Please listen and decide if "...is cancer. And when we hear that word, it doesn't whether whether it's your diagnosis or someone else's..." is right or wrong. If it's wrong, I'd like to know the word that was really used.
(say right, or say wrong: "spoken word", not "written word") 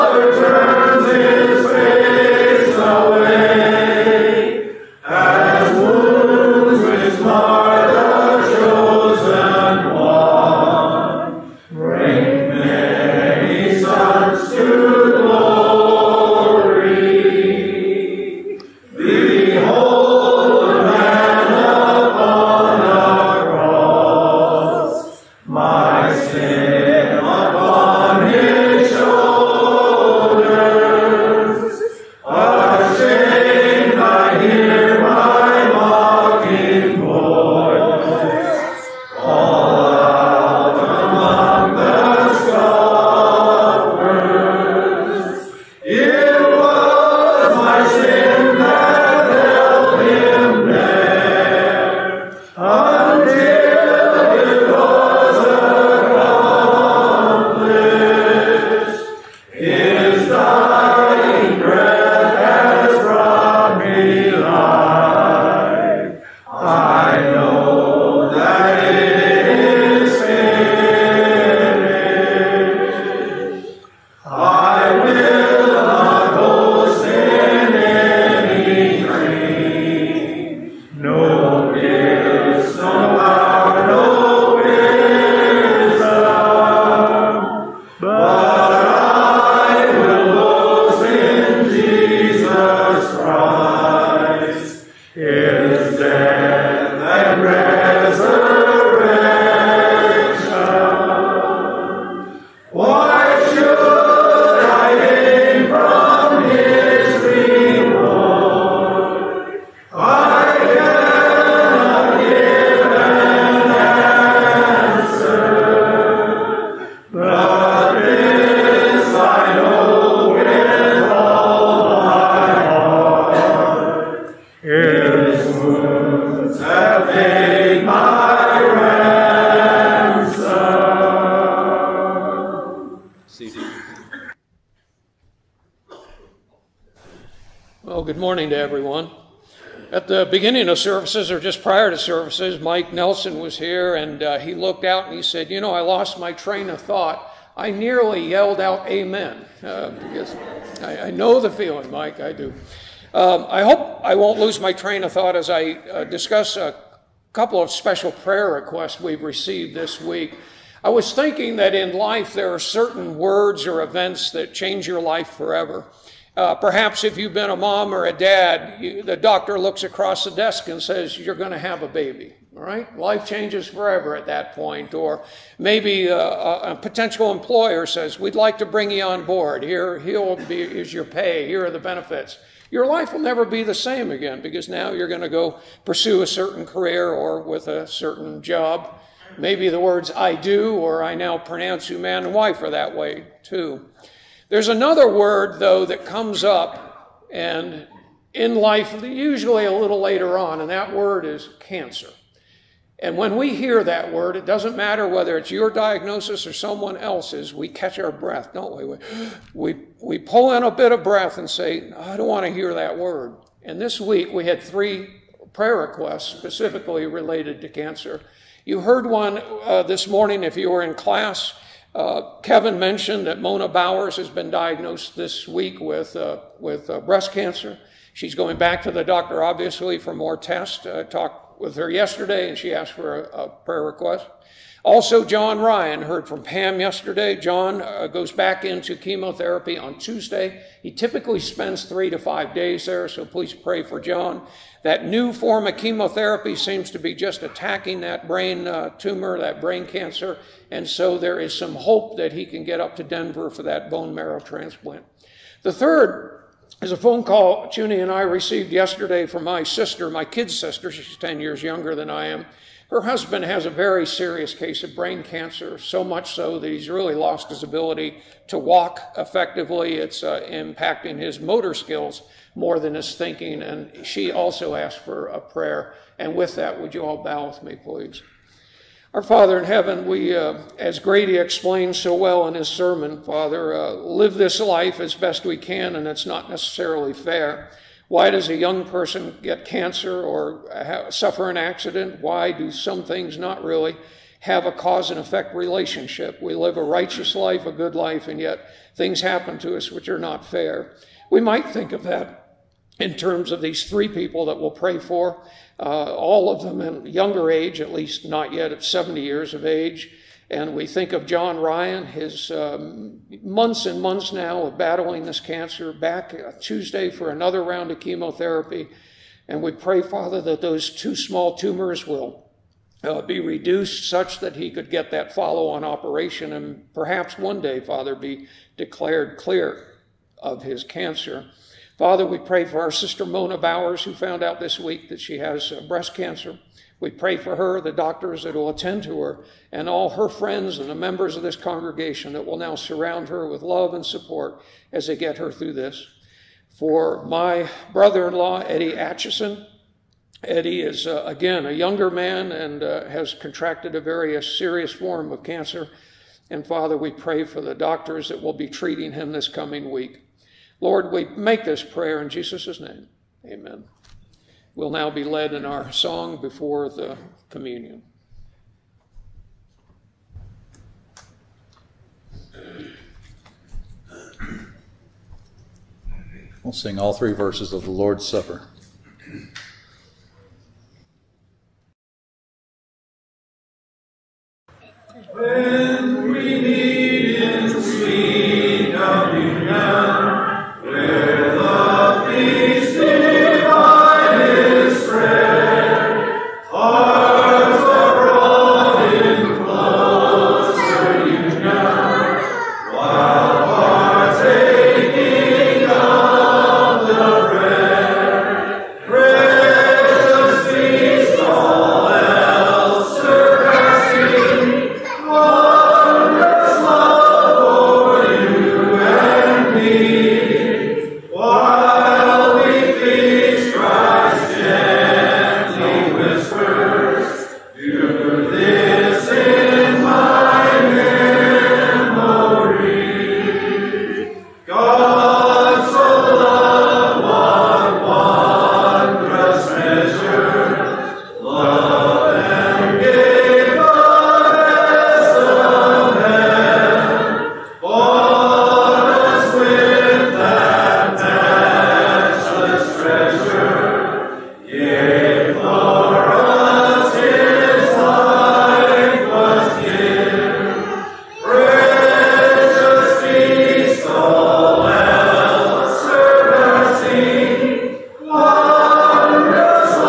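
wrong: "matter", not "whether".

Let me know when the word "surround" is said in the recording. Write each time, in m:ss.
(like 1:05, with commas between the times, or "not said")
5:42.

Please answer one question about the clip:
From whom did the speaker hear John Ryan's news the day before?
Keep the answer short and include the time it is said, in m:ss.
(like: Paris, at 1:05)
Pam, at 3:56.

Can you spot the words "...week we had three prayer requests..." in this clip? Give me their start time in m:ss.
3:34.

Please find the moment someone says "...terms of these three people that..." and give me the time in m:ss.
5:03.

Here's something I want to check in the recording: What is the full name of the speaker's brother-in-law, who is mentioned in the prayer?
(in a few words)
Eddie Atchison.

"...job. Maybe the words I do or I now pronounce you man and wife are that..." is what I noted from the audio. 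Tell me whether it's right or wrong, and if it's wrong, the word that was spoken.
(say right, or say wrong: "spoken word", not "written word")
right.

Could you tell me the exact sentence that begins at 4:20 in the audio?
She's 10 years younger than I am.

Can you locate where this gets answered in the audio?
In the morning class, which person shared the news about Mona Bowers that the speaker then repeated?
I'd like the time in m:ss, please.
3:42.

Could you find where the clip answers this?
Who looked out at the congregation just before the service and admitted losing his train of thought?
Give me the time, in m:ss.
2:22.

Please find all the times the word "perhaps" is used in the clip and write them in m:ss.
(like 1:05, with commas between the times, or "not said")
2:46, 5:26.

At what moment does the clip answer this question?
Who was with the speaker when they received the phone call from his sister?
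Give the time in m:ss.
4:17.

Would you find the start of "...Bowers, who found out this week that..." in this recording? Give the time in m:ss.
5:33.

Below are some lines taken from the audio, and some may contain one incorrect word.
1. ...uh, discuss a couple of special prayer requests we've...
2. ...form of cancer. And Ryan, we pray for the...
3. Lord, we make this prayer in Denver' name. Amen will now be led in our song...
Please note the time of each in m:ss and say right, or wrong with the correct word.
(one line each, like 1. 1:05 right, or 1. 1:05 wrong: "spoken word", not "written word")
1. 2:35 right
2. 5:54 wrong: "Father", not "Ryan"
3. 6:00 wrong: "Jesus", not "Denver".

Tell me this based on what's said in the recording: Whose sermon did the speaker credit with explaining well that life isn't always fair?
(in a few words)
Grady.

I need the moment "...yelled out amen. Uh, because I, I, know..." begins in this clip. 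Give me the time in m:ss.
2:28.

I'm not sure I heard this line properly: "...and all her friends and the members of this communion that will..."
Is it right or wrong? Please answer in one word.
wrong.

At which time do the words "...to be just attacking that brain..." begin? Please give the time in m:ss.
4:06.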